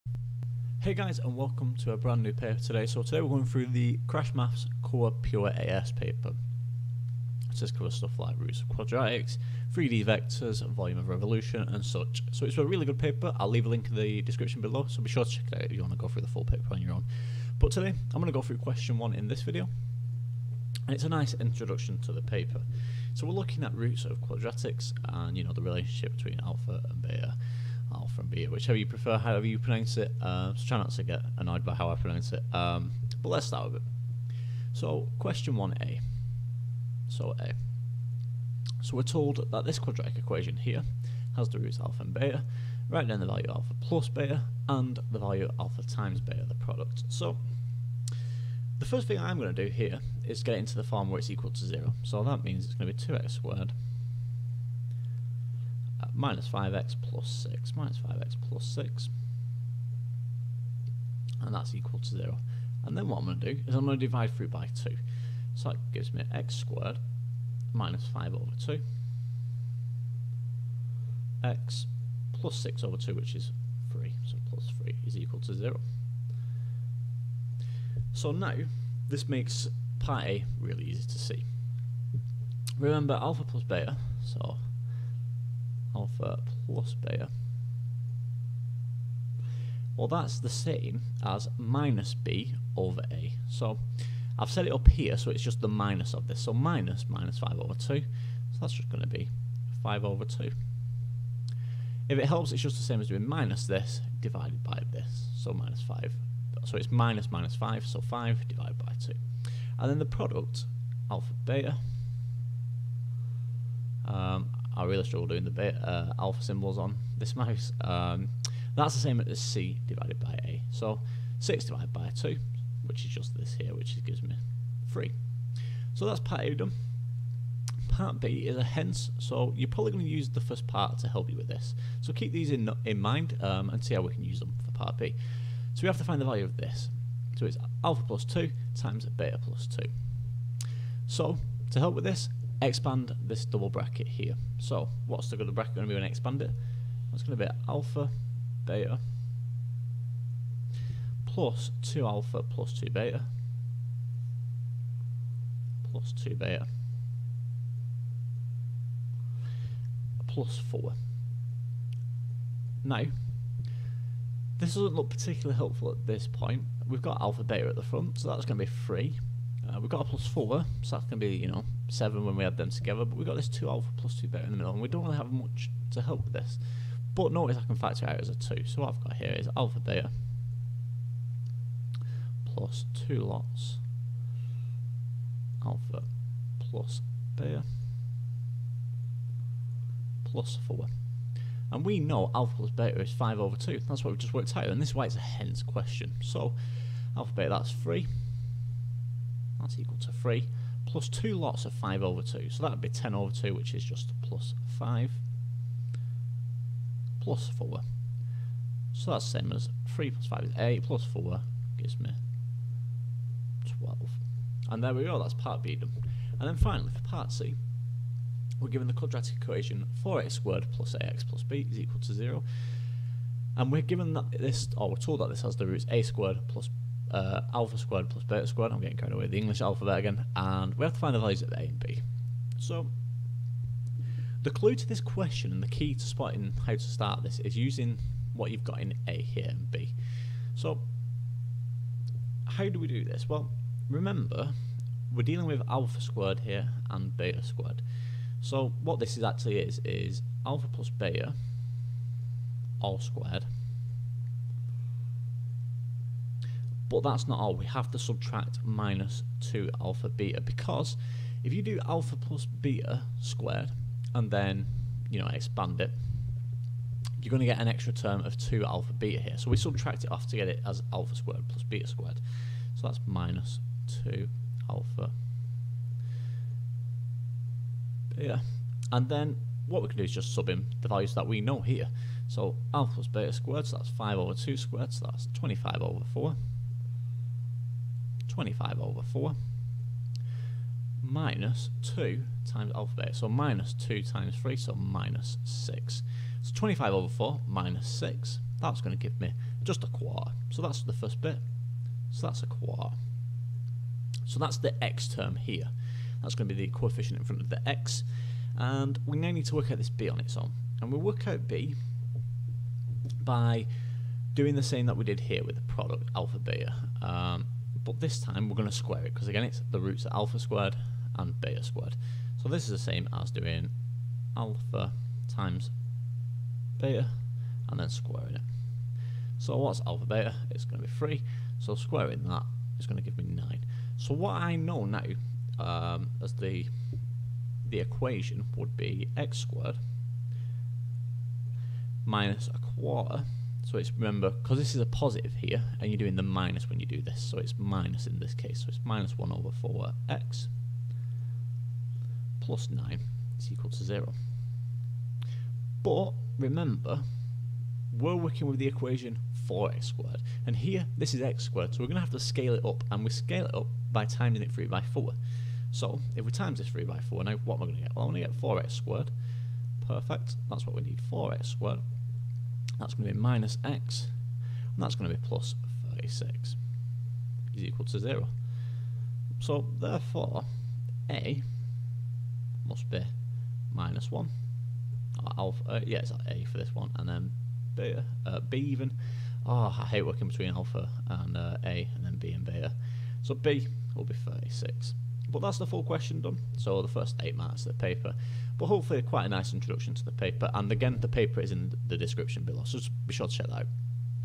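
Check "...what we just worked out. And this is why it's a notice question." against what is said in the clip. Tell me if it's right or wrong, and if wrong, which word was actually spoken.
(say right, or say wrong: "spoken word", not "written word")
wrong: "hence", not "notice".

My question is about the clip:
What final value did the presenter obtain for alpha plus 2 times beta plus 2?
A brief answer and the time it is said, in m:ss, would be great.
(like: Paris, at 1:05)
12, at 3:33.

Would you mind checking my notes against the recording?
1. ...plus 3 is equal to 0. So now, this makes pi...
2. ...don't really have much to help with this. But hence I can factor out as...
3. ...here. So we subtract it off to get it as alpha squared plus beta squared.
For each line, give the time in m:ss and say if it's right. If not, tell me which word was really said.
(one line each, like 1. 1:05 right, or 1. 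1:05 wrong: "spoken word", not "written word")
1. 1:14 right
2. 2:54 wrong: "notice", not "hence"
3. 4:29 right.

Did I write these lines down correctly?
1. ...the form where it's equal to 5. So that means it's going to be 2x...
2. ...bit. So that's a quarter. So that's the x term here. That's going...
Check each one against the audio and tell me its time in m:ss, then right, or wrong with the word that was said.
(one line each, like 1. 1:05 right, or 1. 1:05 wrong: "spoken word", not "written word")
1. 0:50 wrong: "0", not "5"
2. 5:01 right.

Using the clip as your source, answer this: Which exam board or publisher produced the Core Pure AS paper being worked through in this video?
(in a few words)
CrashMaths.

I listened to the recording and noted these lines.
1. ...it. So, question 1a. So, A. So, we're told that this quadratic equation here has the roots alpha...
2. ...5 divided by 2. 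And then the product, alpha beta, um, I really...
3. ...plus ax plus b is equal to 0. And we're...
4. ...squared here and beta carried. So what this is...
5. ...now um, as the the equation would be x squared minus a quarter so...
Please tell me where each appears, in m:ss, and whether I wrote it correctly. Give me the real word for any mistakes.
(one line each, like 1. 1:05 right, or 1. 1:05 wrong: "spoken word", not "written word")
1. 0:33 right
2. 1:48 right
3. 3:40 right
4. 4:05 wrong: "squared", not "carried"
5. 5:34 right.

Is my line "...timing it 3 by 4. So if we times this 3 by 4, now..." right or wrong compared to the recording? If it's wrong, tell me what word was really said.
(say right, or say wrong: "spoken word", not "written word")
right.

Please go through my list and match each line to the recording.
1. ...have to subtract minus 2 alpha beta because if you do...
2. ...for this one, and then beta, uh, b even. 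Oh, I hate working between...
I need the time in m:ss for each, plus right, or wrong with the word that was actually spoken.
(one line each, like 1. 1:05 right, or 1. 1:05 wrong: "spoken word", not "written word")
1. 4:17 right
2. 6:26 right.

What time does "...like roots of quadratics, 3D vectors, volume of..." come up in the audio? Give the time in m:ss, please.
0:08.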